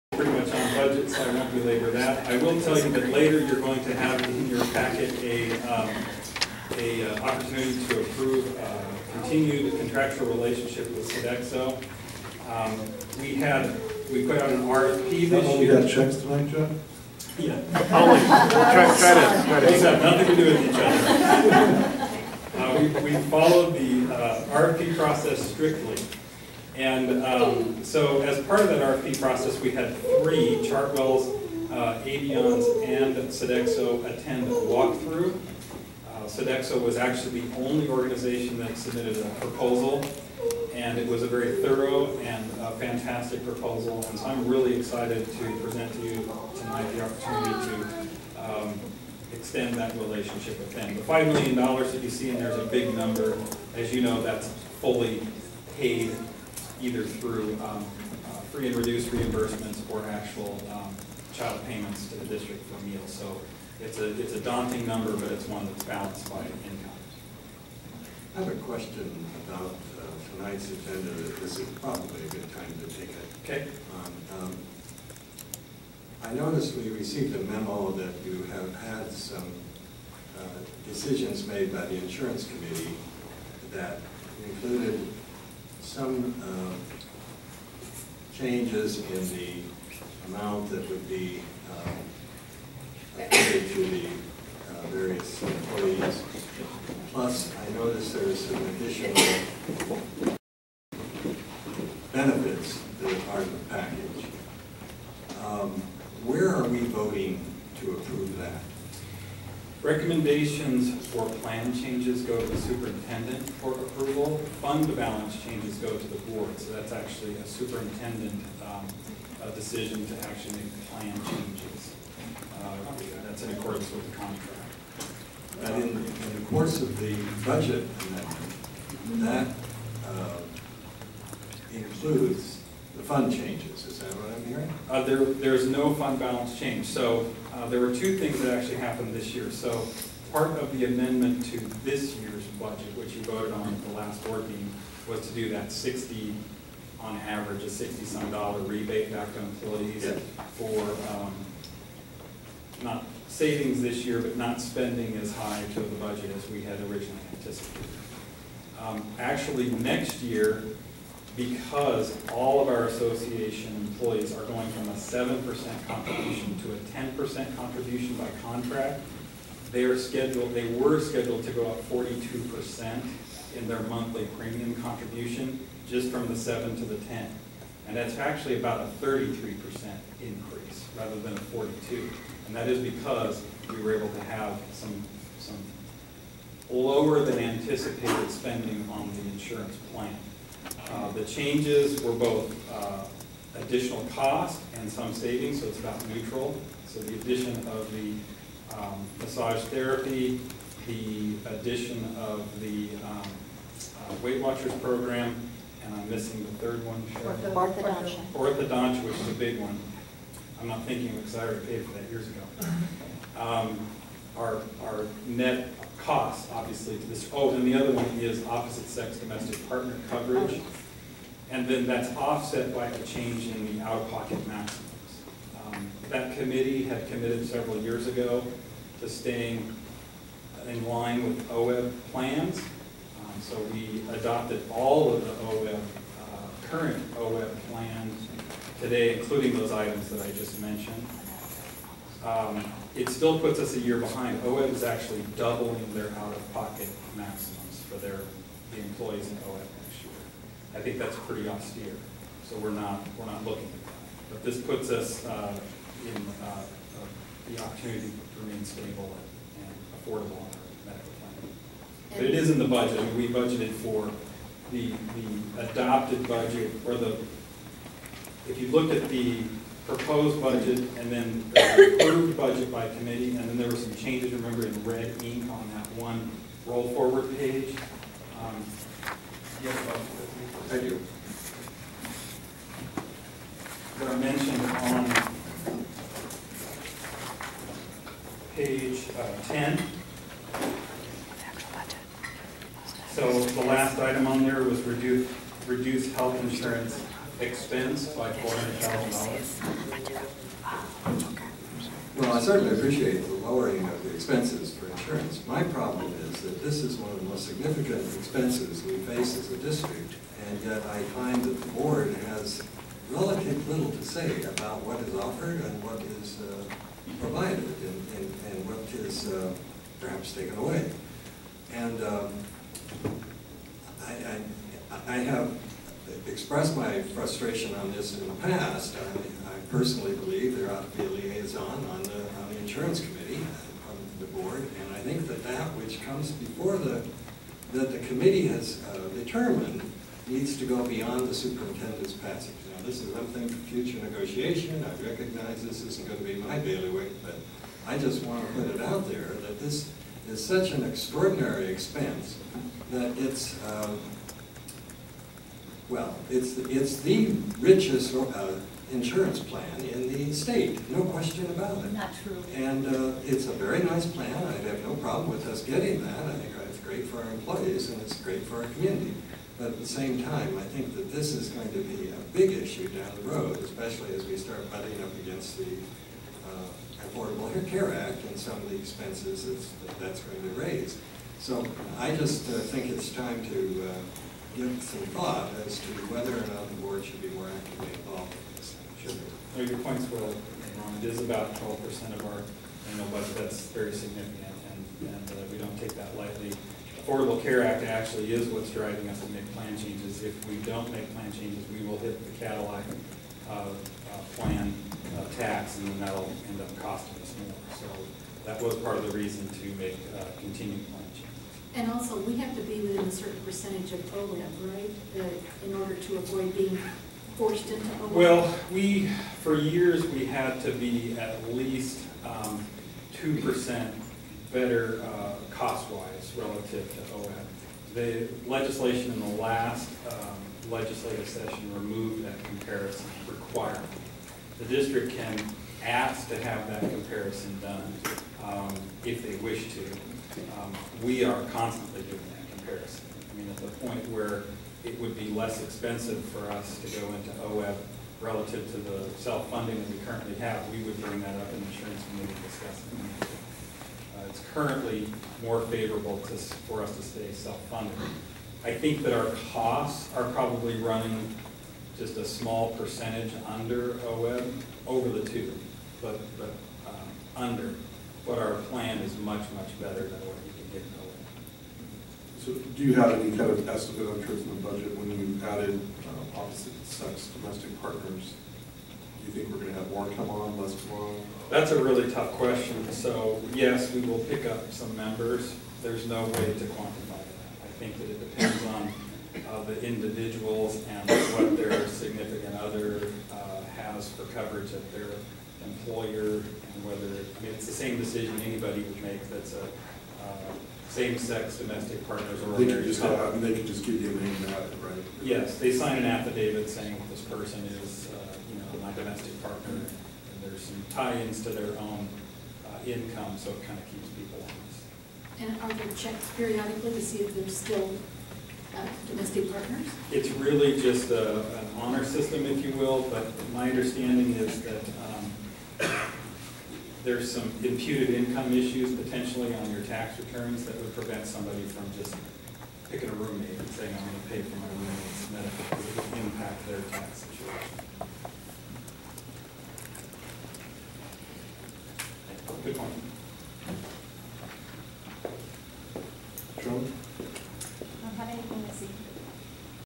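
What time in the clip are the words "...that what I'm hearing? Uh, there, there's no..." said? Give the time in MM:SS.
02:13.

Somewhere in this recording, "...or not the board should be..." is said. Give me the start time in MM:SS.
06:26.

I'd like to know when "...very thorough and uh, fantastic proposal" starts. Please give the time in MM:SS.
00:41.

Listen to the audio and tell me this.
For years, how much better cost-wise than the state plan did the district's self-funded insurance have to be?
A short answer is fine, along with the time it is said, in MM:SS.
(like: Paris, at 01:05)
2%, at 07:03.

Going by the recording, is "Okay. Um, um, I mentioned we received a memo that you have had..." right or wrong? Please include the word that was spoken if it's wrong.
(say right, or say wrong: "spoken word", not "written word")
wrong: "noticed", not "mentioned".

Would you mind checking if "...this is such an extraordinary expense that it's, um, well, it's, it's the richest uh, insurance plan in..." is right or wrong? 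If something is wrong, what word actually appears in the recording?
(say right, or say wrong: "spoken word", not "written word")
right.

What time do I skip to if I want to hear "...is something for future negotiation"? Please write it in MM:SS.
05:43.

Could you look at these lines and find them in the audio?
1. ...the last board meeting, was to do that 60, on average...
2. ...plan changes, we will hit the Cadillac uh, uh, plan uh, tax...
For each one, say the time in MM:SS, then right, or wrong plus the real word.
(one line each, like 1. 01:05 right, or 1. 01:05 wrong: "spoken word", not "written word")
1. 02:23 right
2. 06:41 right.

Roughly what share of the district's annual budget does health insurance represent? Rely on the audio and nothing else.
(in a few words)
12%.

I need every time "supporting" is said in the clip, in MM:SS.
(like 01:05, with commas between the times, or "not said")
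not said.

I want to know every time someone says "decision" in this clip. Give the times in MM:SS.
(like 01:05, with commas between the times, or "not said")
01:20, 01:59, 08:17.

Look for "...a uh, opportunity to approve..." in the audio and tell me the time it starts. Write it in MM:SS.
00:06.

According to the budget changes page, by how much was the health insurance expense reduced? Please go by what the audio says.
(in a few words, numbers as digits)
$400,000.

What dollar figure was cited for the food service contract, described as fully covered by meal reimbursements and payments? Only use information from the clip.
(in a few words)
$5 million.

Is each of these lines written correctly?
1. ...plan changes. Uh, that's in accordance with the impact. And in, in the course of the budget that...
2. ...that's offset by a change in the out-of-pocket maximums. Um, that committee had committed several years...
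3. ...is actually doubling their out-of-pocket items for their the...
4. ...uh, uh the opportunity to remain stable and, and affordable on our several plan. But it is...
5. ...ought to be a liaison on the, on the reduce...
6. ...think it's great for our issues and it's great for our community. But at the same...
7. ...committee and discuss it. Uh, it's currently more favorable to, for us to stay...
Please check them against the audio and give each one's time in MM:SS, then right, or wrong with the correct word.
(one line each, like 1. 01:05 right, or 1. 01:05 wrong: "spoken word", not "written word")
1. 02:00 wrong: "contract", not "impact"
2. 03:41 right
3. 04:04 wrong: "maximums", not "items"
4. 04:16 wrong: "medical", not "several"
5. 05:30 wrong: "insurance", not "reduce"
6. 06:06 wrong: "employees", not "issues"
7. 07:32 right.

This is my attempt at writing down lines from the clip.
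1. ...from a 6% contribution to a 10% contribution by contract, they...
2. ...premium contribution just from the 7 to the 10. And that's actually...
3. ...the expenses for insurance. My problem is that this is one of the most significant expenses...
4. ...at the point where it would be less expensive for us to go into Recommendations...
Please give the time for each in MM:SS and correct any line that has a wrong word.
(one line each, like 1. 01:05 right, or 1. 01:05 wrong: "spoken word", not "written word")
1. 02:44 wrong: "7", not "6"
2. 02:54 right
3. 05:04 right
4. 07:23 wrong: "OEB", not "Recommendations".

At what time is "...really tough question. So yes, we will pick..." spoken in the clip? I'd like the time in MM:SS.
08:01.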